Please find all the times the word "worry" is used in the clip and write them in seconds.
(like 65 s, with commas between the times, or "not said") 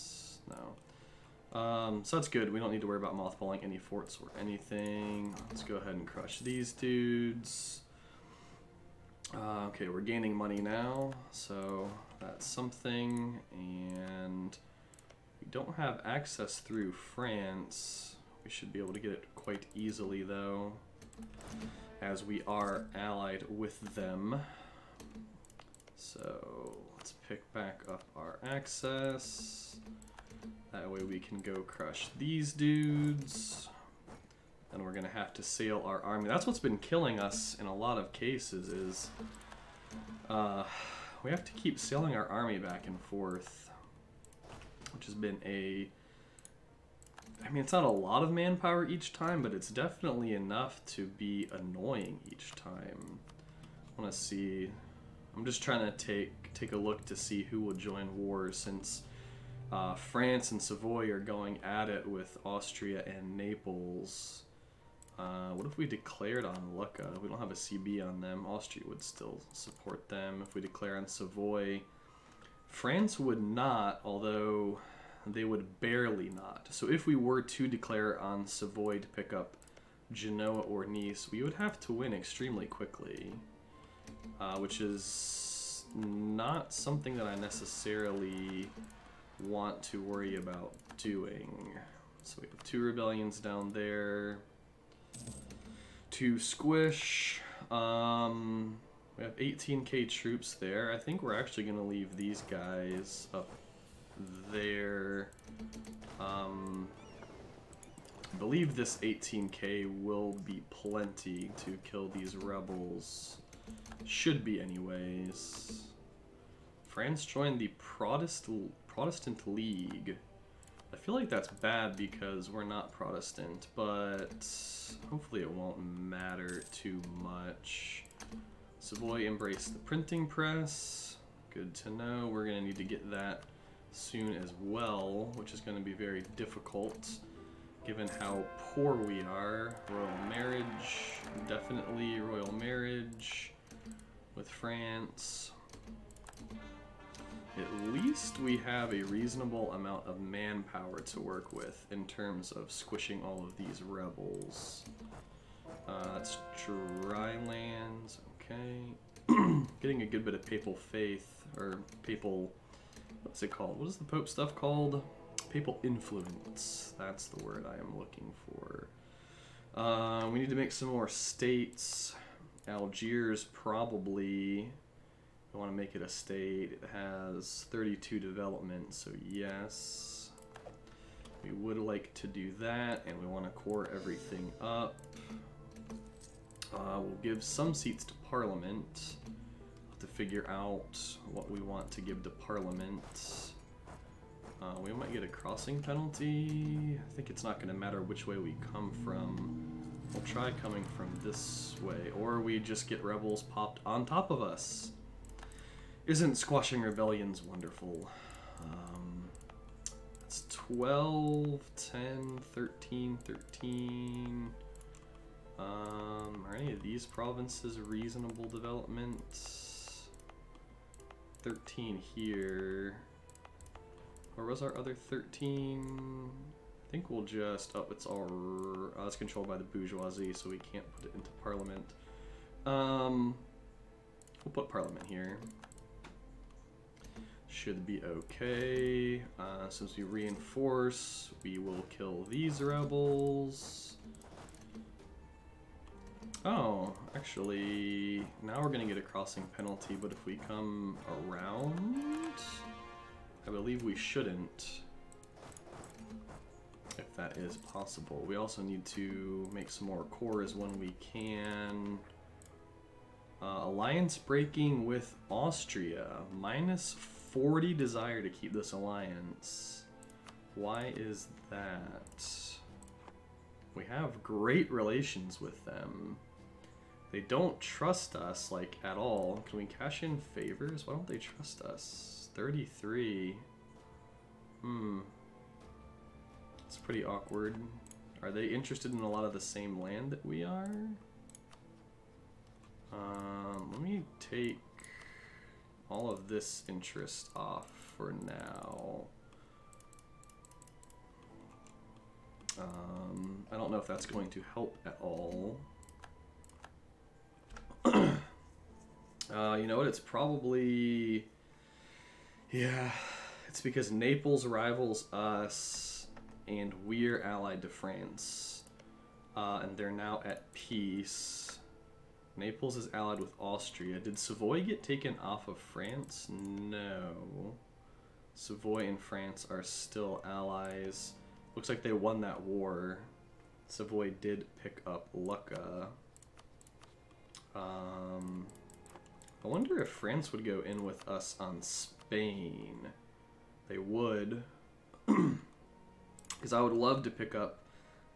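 2 s, 90 s.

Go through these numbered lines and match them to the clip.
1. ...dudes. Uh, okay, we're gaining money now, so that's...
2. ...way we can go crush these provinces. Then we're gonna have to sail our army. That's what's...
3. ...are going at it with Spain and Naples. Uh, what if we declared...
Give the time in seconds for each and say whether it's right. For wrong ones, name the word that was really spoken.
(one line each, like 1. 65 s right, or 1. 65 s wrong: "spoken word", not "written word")
1. 6 s right
2. 30 s wrong: "dudes", not "provinces"
3. 61 s wrong: "Austria", not "Spain".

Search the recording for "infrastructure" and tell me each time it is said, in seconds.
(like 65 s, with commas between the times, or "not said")
not said.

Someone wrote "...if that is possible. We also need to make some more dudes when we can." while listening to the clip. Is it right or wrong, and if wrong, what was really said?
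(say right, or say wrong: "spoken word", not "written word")
wrong: "cores", not "dudes".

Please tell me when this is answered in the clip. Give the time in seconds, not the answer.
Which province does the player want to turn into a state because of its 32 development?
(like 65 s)
172 s.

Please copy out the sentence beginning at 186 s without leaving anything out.
Uh, we'll give some seats to Parliament.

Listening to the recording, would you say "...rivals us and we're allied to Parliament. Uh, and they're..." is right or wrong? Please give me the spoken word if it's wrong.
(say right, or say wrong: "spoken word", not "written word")
wrong: "France", not "Parliament".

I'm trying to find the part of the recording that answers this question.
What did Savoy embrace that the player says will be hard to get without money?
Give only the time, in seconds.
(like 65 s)
129 s.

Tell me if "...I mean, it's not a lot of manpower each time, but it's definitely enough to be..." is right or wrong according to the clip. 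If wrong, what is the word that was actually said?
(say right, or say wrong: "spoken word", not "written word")
right.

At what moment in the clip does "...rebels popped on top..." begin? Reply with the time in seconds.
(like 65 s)
203 s.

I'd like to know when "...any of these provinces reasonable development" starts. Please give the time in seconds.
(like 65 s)
216 s.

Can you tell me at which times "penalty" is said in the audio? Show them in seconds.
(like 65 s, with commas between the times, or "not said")
195 s, 249 s.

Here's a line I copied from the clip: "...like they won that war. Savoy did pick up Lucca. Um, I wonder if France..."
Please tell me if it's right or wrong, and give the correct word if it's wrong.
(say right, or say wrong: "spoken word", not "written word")
right.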